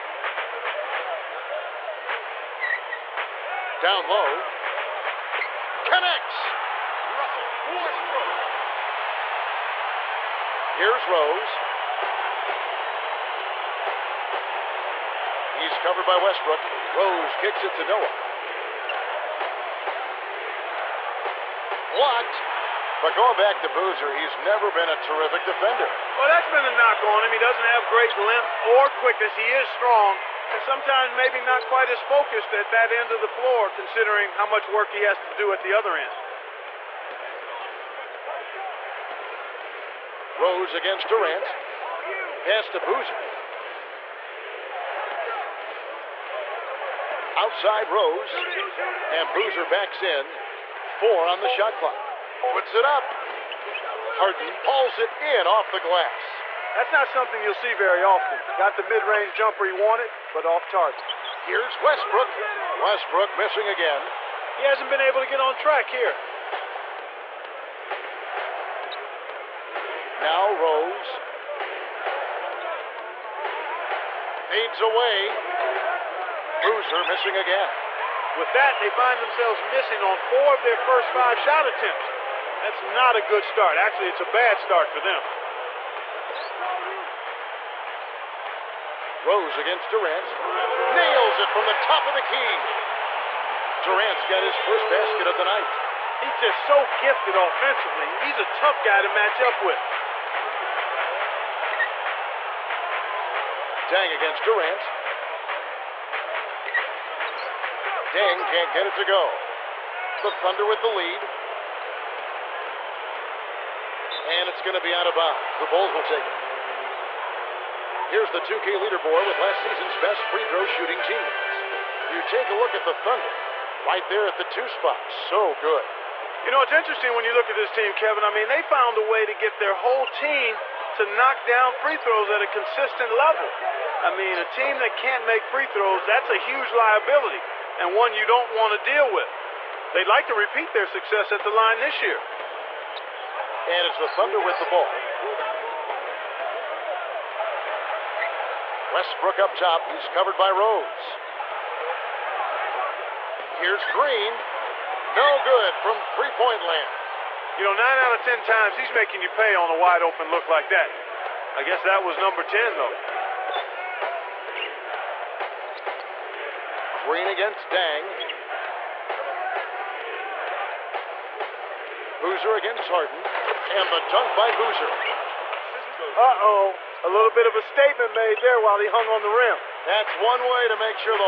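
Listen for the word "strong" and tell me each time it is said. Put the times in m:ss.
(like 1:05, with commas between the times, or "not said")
0:29.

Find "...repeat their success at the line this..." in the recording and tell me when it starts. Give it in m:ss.
2:20.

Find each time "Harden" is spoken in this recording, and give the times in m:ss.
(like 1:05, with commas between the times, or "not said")
0:54, 2:52.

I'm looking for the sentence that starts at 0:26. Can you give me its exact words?
Well, that's been a knock on him.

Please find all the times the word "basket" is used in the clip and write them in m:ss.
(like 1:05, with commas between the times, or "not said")
1:34.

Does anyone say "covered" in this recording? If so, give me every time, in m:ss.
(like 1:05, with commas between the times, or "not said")
0:15, 2:30.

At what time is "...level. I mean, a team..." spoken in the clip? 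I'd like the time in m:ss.
2:13.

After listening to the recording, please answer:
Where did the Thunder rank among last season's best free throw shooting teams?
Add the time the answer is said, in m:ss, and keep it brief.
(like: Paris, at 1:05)
2, at 2:04.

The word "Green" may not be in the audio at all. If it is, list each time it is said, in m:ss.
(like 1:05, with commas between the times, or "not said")
2:33, 2:47.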